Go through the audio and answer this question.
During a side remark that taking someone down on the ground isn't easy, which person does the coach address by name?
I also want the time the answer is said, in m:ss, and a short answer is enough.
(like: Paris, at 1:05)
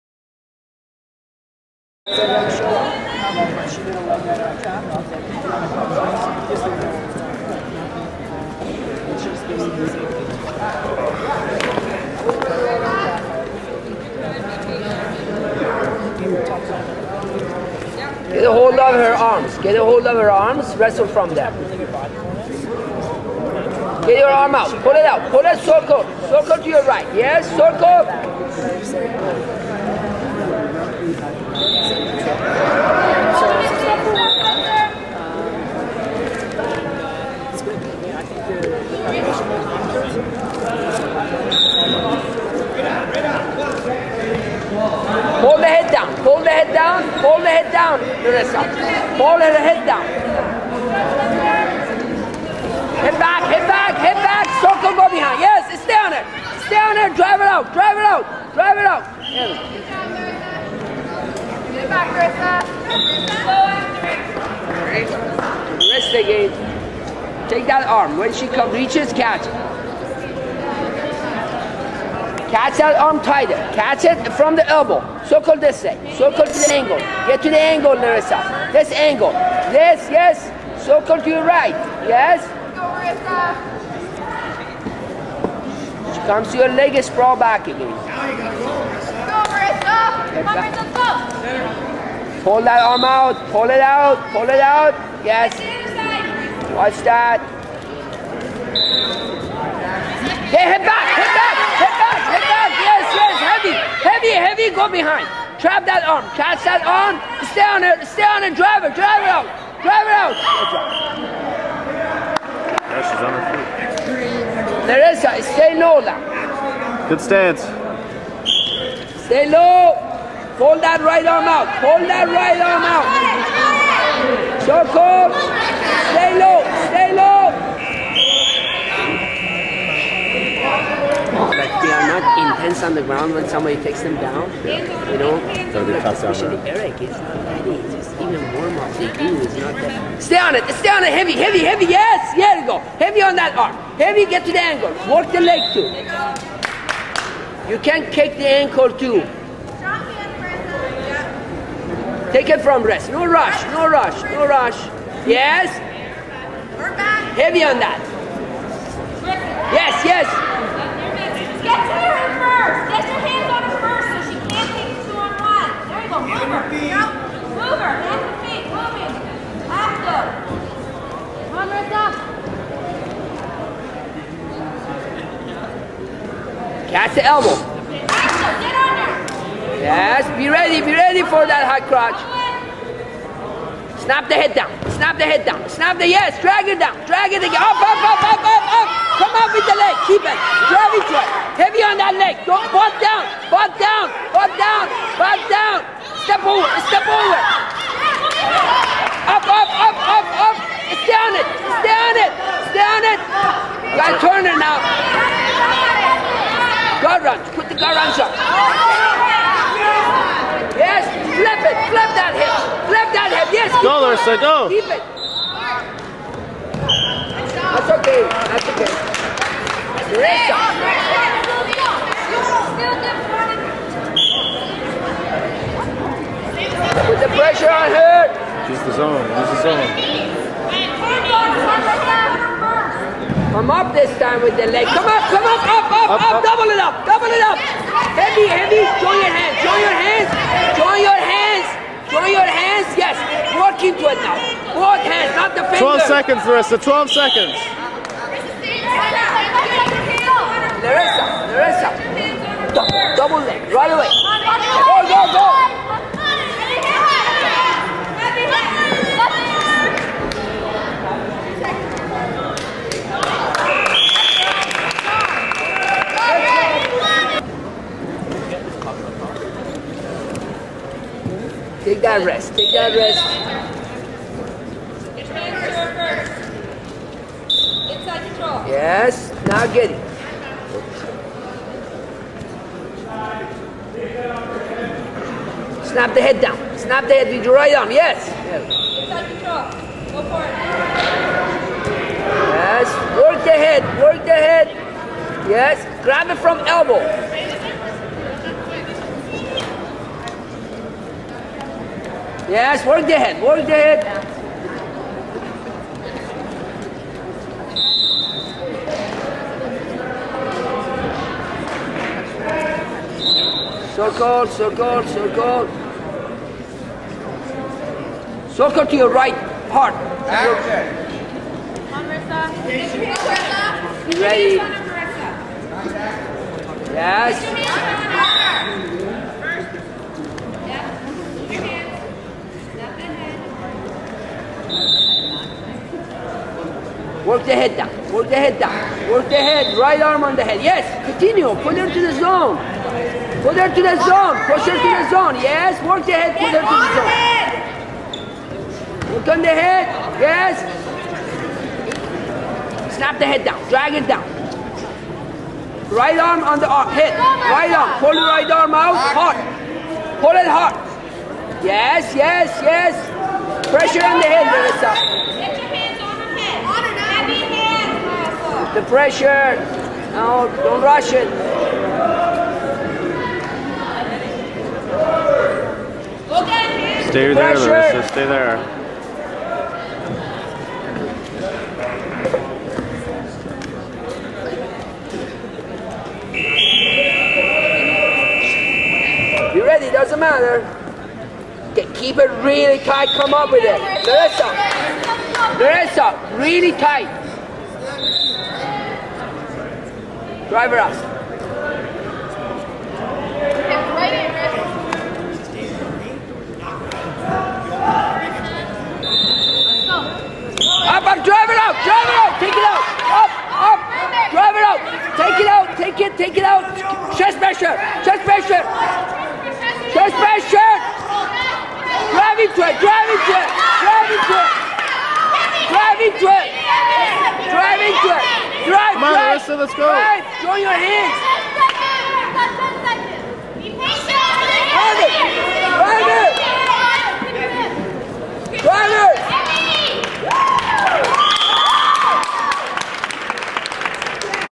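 Eric, at 2:16.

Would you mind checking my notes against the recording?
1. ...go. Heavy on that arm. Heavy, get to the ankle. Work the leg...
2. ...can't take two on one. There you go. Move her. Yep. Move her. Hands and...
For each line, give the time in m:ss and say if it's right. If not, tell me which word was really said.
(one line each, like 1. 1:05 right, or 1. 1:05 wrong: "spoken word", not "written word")
1. 2:22 right
2. 2:44 right.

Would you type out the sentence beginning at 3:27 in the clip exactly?
Guard run, put the guard runs up.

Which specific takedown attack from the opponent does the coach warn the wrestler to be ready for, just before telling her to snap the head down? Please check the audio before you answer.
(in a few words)
high crotch.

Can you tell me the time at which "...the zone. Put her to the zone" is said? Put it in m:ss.
5:42.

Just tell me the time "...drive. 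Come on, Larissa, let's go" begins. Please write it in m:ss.
7:08.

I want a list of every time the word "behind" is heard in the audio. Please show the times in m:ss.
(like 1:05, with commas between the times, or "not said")
0:55, 1:44.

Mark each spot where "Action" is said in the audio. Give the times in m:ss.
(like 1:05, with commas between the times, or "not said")
5:20.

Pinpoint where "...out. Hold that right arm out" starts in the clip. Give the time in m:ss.
2:01.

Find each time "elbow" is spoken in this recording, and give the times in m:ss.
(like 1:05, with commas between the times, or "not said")
1:14, 2:57, 4:56.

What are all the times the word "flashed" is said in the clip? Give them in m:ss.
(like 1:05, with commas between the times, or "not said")
not said.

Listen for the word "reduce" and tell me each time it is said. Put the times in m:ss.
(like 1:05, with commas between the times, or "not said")
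not said.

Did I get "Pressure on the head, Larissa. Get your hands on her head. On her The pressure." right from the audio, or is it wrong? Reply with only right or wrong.
right.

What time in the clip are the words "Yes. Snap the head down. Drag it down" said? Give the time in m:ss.
5:50.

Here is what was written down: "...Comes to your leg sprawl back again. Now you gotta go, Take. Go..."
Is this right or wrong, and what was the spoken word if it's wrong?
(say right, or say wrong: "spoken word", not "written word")
wrong: "Marissa", not "Take".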